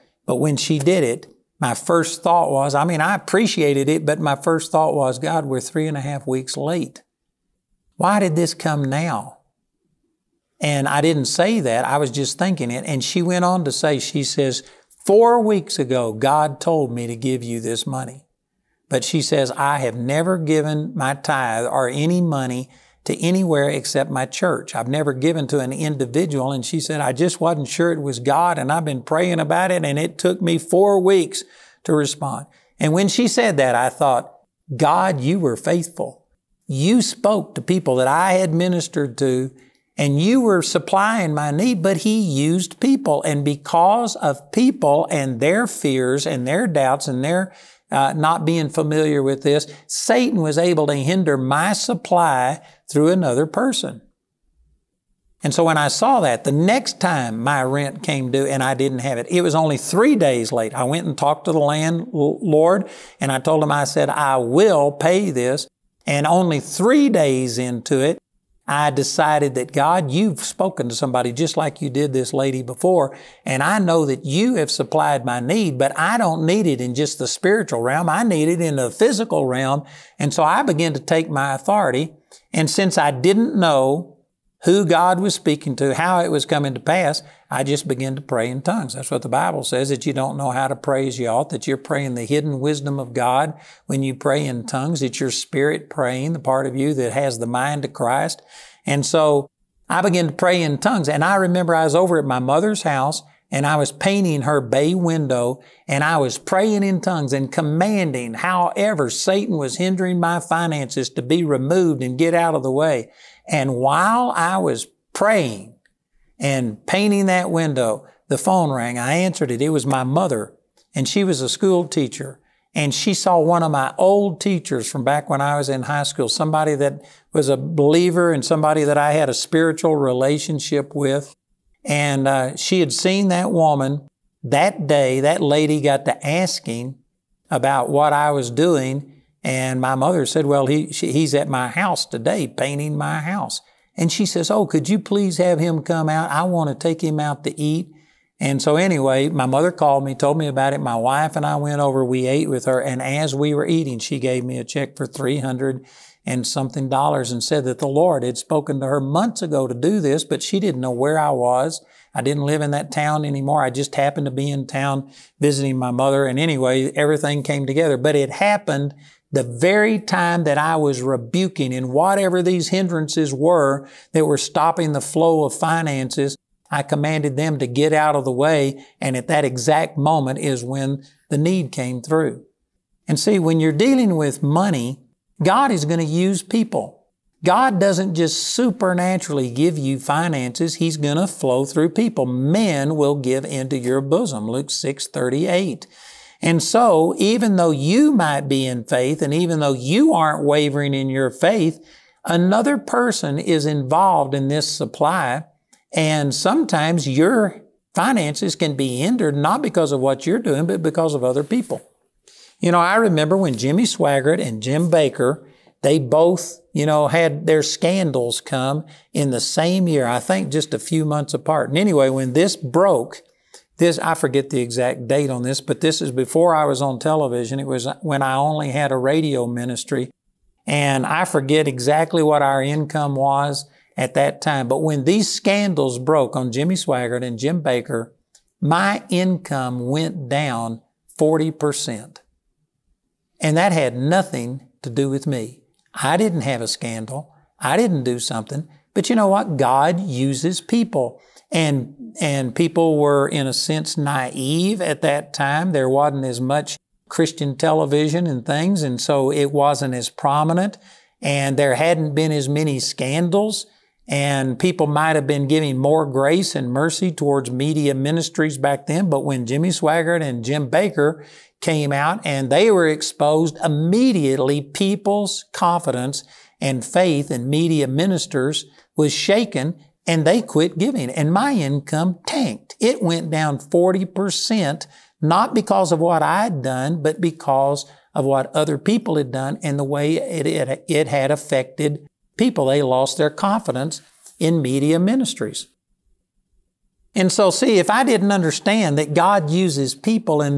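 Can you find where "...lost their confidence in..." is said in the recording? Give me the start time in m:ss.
4:52.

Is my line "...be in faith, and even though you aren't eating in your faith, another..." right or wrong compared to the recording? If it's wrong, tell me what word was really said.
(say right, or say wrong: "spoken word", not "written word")
wrong: "wavering", not "eating".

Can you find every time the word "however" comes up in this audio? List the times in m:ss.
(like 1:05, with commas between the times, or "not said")
1:48.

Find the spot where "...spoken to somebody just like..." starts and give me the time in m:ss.
1:10.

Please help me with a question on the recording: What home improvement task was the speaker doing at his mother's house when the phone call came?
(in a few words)
Painting her bay window.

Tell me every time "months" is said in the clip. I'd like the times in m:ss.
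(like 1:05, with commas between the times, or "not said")
2:38, 3:41.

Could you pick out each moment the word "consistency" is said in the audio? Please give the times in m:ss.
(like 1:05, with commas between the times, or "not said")
not said.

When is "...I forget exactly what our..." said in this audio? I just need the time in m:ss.
3:51.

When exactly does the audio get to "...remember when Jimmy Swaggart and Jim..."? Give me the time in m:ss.
3:32.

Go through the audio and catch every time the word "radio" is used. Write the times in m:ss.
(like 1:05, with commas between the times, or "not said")
3:48.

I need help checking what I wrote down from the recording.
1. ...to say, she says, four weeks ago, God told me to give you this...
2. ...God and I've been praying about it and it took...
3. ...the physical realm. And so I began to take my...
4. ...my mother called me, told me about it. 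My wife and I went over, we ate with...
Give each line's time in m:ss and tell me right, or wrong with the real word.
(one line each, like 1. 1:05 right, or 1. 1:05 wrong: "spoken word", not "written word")
1. 0:13 right
2. 0:28 right
3. 1:18 right
4. 2:29 right.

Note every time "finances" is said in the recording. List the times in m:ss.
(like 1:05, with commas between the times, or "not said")
1:50, 2:55, 3:09, 3:27.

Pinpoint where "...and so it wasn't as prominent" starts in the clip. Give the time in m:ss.
4:18.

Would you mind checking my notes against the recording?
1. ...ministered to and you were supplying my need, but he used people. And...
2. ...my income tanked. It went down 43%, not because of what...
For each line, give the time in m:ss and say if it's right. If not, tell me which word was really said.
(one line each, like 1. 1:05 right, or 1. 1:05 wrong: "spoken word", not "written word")
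1. 0:38 right
2. 4:41 wrong: "40", not "43".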